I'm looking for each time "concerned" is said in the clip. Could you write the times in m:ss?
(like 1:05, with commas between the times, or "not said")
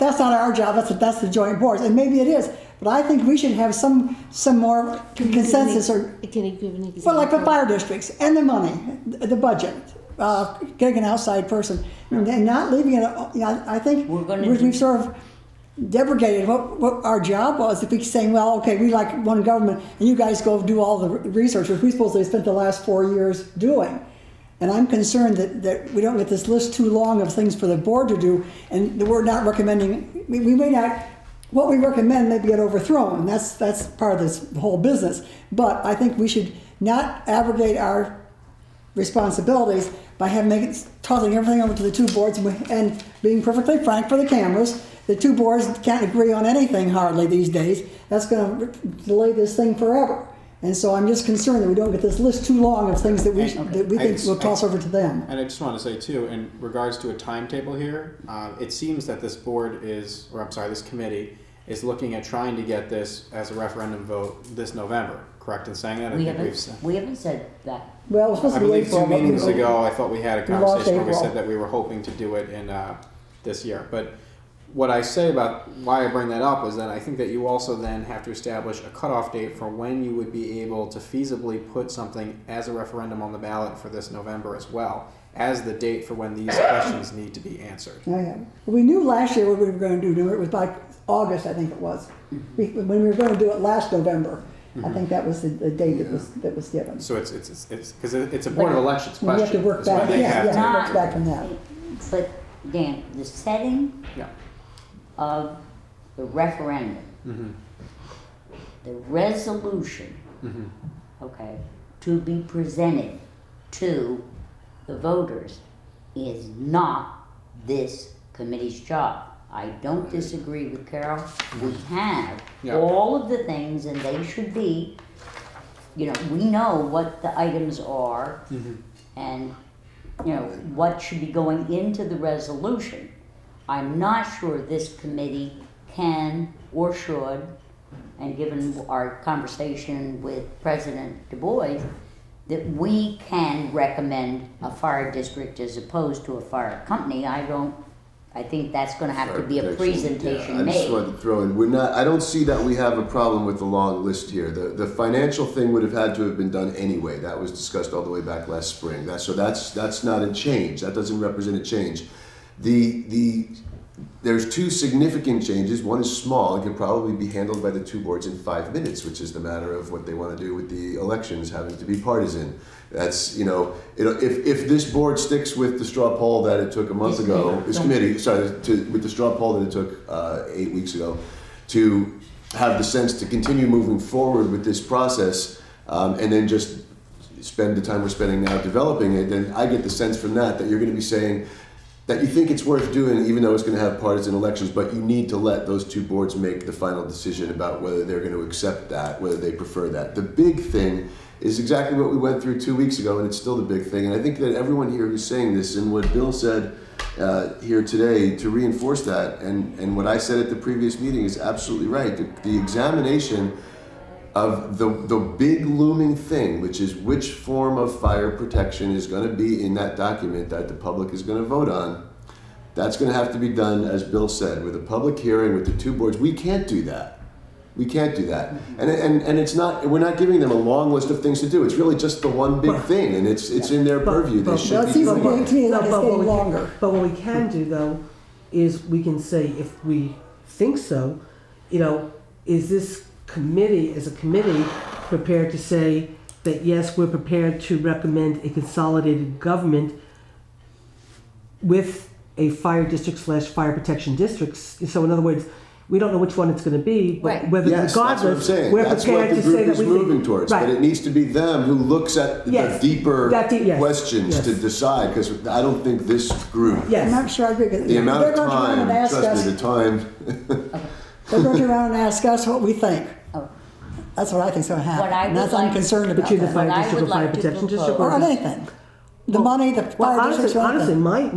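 0:24, 0:51, 4:35.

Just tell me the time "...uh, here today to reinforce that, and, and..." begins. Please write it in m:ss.
3:27.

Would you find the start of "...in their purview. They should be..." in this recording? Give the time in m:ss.
3:53.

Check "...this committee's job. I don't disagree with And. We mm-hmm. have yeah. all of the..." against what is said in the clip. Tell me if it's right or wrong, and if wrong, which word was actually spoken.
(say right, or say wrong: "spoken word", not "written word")
wrong: "Carol", not "And".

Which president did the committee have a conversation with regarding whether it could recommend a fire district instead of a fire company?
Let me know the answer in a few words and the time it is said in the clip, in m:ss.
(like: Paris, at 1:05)
President Du Bois, at 2:20.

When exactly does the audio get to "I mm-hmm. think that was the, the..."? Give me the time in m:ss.
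1:34.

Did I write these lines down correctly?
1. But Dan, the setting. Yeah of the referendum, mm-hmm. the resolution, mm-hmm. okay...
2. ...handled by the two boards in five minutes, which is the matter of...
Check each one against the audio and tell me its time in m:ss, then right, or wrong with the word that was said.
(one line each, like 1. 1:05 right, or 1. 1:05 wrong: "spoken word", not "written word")
1. 1:42 right
2. 2:47 right.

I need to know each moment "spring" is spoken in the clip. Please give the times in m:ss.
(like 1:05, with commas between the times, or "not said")
2:38.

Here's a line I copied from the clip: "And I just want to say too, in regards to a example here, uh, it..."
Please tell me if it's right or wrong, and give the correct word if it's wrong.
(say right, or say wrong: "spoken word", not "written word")
wrong: "timetable", not "example".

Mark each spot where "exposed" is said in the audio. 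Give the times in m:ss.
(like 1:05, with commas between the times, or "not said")
not said.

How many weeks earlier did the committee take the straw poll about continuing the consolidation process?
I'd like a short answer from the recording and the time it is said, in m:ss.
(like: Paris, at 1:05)
8, at 3:00.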